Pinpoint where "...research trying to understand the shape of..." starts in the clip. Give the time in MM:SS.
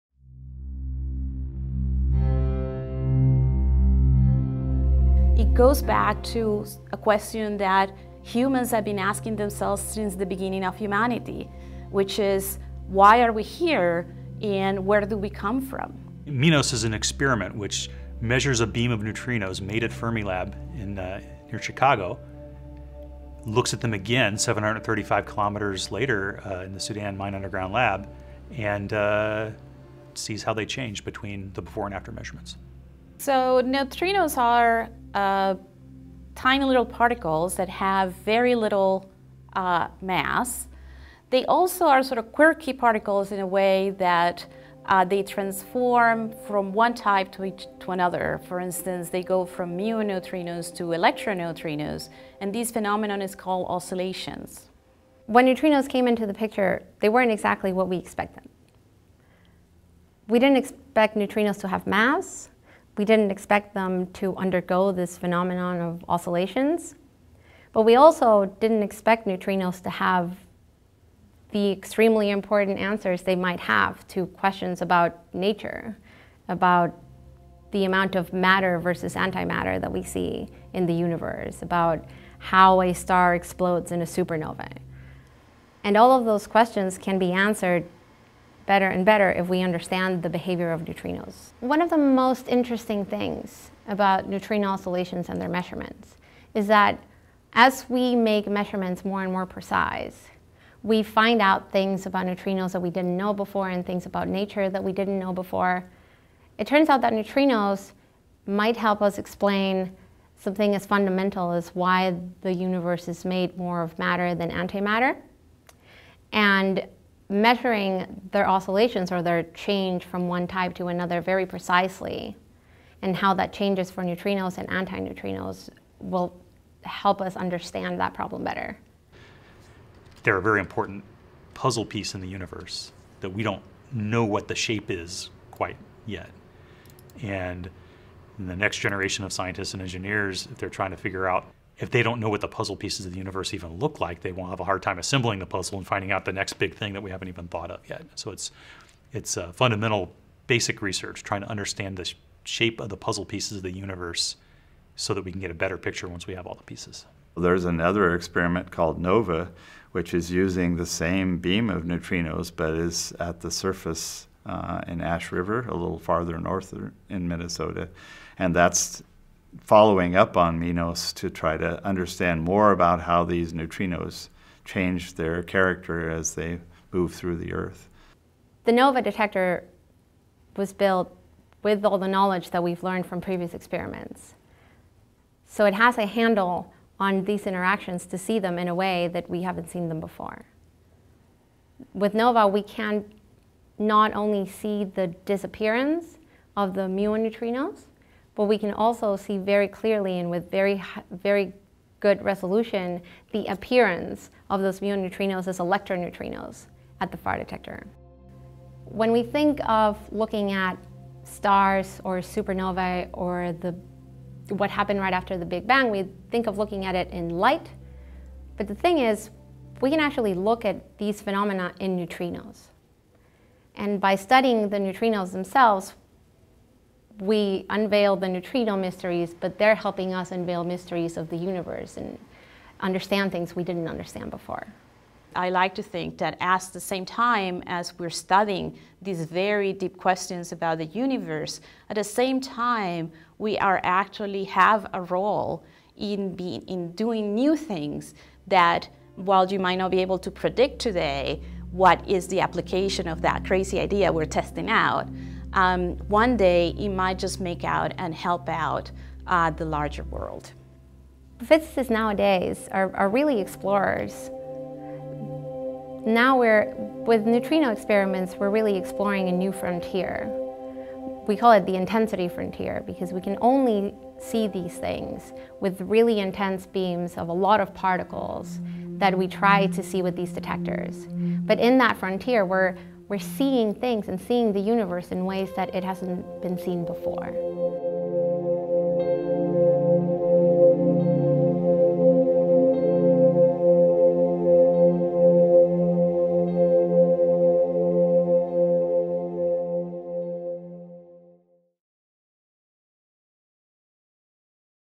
02:30.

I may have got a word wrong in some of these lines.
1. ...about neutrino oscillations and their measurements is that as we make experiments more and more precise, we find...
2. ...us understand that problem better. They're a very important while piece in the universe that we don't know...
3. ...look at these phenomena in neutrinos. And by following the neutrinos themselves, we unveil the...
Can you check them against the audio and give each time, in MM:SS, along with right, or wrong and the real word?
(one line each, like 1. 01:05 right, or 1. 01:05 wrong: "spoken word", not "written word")
1. 01:33 wrong: "measurements", not "experiments"
2. 02:07 wrong: "puzzle", not "while"
3. 03:40 wrong: "studying", not "following".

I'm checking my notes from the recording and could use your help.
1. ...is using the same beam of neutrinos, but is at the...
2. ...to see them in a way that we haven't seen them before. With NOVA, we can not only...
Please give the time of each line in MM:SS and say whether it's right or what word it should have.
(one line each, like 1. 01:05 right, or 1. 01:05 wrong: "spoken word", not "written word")
1. 02:40 right
2. 03:08 right.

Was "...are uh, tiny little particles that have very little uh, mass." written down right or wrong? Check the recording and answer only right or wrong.
right.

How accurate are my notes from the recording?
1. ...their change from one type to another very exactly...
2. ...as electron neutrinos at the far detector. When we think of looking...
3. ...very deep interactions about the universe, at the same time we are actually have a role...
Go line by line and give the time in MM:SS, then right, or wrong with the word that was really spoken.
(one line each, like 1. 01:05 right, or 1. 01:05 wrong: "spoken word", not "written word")
1. 01:59 wrong: "precisely", not "exactly"
2. 03:25 right
3. 03:59 wrong: "questions", not "interactions".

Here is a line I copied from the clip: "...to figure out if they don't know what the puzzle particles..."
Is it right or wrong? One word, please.
wrong.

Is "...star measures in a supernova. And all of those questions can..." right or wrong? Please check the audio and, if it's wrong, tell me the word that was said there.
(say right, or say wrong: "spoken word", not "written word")
wrong: "explodes", not "measures".